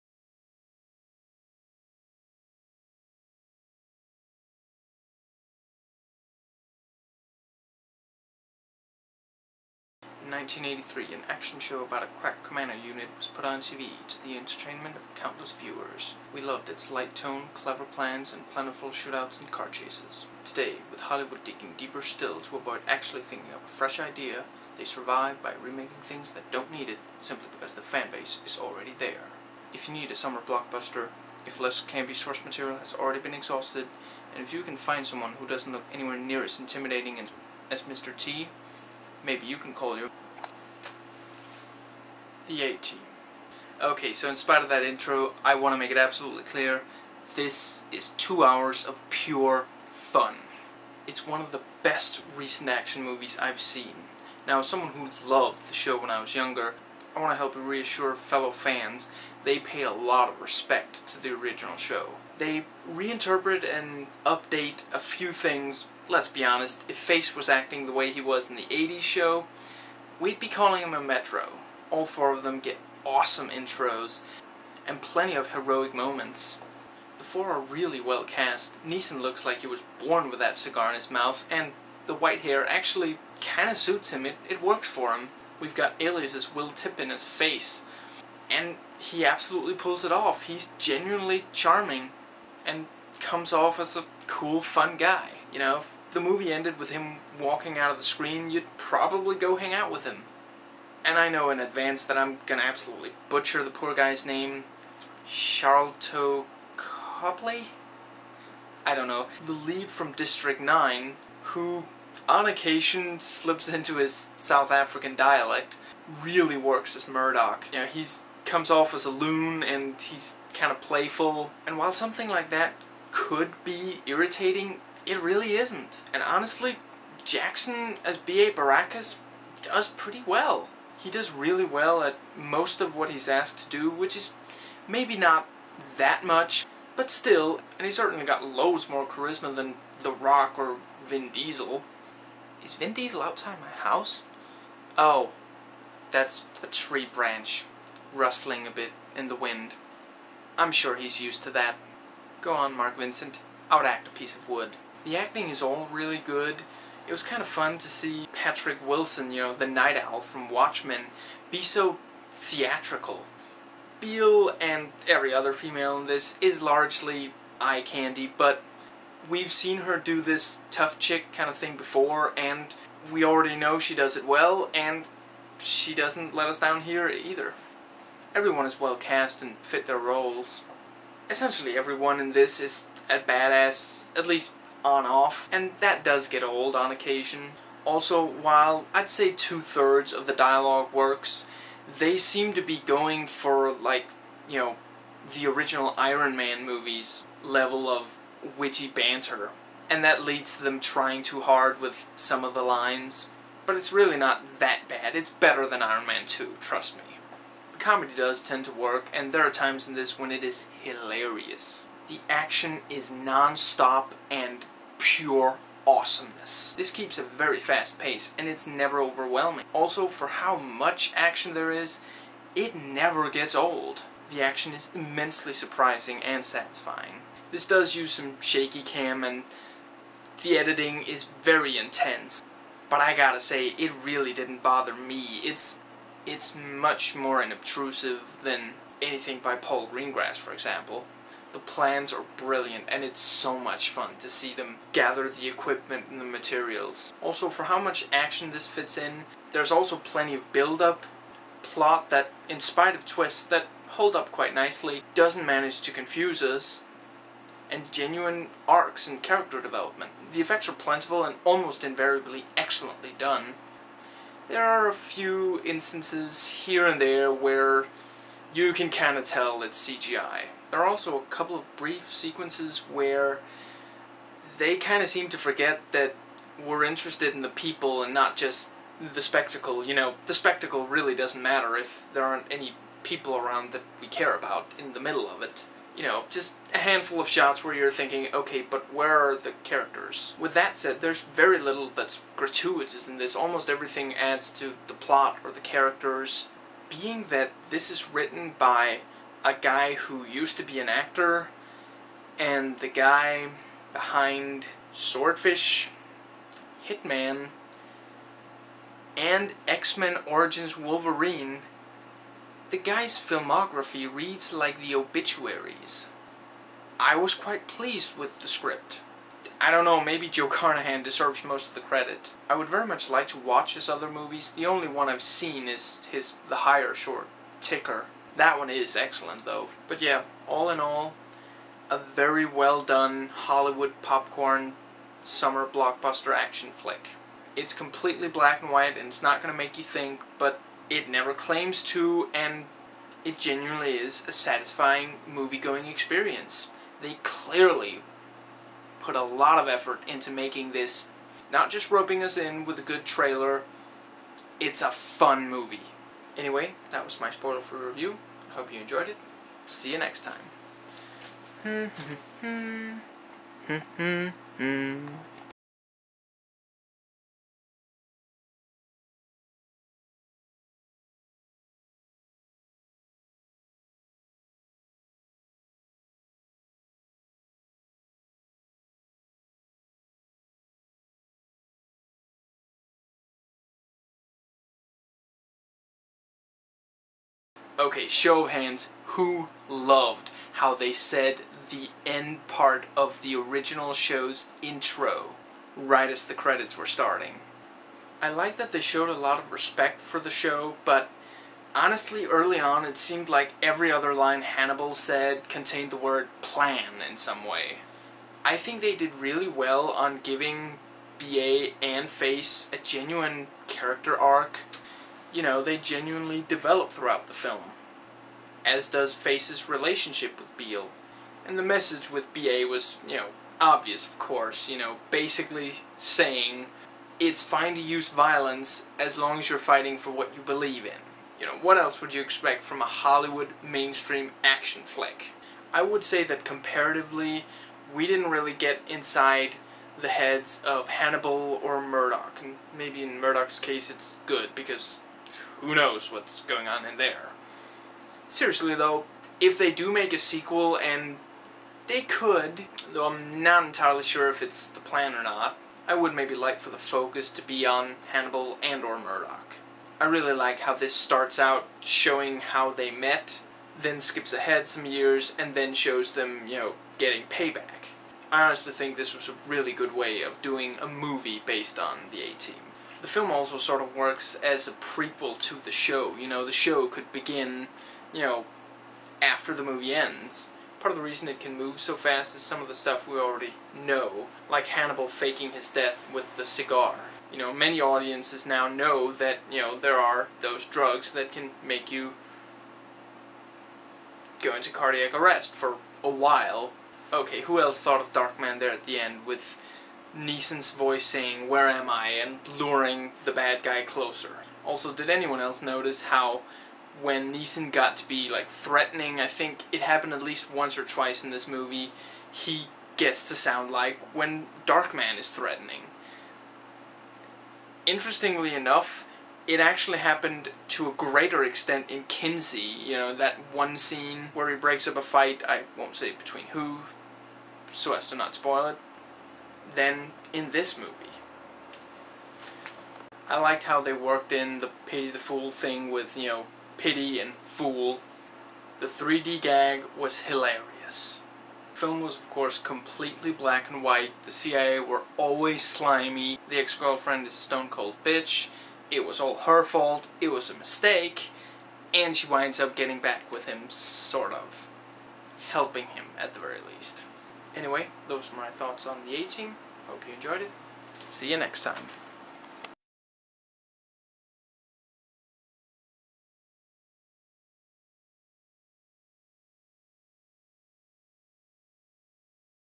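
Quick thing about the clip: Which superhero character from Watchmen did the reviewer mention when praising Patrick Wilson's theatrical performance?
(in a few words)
Night Owl.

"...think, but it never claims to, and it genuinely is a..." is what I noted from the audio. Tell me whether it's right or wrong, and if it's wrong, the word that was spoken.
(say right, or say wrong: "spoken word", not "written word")
right.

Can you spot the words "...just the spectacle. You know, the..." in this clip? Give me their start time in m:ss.
4:38.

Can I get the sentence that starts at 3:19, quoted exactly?
And that leads to them trying too hard with some of the lines.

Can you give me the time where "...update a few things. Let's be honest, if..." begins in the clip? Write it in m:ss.
1:04.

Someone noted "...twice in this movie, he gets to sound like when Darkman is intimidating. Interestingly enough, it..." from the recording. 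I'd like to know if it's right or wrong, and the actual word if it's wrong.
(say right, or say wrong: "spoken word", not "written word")
wrong: "threatening", not "intimidating".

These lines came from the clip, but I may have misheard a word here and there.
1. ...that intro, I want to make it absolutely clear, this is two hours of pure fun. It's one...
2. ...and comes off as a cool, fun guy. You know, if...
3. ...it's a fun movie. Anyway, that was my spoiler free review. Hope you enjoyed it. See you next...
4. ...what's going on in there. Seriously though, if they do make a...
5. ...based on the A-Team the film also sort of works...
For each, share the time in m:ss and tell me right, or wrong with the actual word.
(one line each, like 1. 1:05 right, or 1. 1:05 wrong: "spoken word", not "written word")
1. 0:44 right
2. 1:32 right
3. 5:54 right
4. 7:26 right
5. 7:51 right.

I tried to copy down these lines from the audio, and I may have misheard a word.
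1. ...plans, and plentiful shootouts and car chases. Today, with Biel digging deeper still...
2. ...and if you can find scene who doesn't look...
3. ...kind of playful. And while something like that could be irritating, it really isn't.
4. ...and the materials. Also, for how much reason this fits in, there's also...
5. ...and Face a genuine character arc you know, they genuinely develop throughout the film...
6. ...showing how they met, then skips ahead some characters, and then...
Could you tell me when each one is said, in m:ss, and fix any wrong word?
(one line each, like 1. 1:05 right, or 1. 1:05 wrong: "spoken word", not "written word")
1. 0:17 wrong: "Hollywood", not "Biel"
2. 0:34 wrong: "someone", not "scene"
3. 2:00 right
4. 4:06 wrong: "action", not "reason"
5. 6:51 right
6. 7:41 wrong: "years", not "characters".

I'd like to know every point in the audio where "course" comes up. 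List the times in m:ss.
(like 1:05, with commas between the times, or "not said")
7:04, 9:02.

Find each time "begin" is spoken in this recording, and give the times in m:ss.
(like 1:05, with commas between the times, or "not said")
7:57.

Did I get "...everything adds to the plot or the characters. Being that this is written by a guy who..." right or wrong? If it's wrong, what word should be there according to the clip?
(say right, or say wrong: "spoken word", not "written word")
right.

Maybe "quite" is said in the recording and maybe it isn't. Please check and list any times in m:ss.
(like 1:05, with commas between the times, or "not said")
4:14, 5:17.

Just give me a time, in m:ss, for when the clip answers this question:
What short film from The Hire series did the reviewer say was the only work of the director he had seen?
5:27.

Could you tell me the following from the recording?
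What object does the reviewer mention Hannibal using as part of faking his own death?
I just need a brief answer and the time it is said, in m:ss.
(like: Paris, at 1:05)
the cigar, at 8:06.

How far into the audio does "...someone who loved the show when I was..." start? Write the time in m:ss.
0:54.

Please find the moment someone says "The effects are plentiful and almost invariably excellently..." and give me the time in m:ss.
4:20.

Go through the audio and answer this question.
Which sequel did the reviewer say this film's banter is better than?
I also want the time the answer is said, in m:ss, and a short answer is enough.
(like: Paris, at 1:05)
Iron Man 2, at 3:25.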